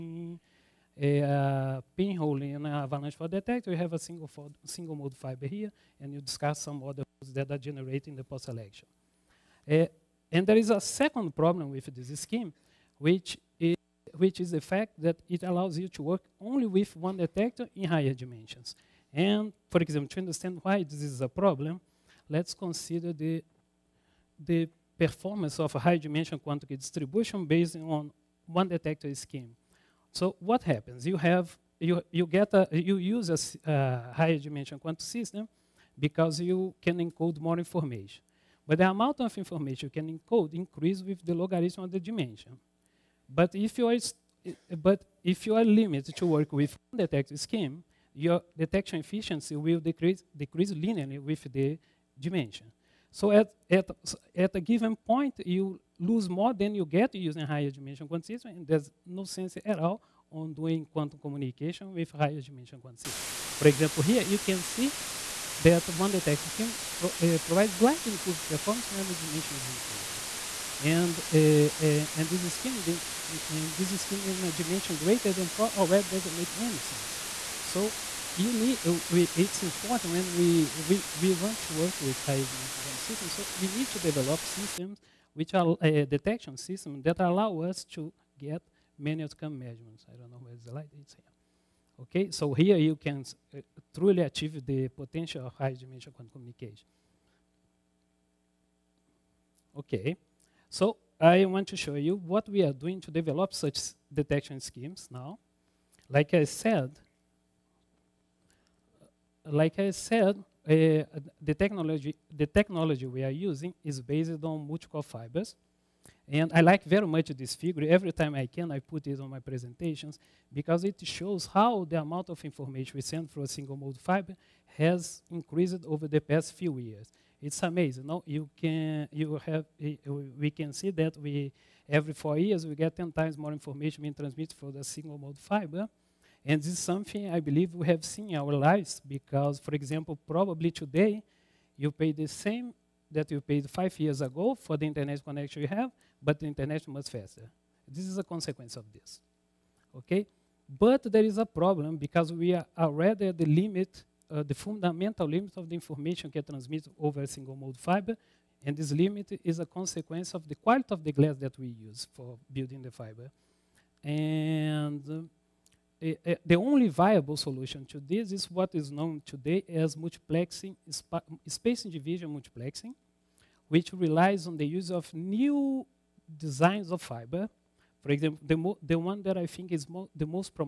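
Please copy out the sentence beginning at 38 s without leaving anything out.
But the amount of information you can encode increase with the logarithm of the dimension.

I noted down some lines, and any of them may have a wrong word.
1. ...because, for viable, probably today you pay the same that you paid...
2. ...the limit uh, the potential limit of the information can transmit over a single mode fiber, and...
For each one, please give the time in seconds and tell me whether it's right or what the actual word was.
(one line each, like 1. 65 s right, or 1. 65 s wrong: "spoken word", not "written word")
1. 139 s wrong: "example", not "viable"
2. 153 s wrong: "fundamental", not "potential".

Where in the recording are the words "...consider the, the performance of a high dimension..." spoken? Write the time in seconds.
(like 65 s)
22 s.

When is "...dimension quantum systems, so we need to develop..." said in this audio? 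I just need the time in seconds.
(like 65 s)
82 s.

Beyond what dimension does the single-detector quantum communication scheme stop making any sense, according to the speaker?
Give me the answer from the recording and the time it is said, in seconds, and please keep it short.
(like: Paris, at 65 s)
4, at 75 s.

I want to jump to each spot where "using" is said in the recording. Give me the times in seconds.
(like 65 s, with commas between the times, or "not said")
57 s, 113 s.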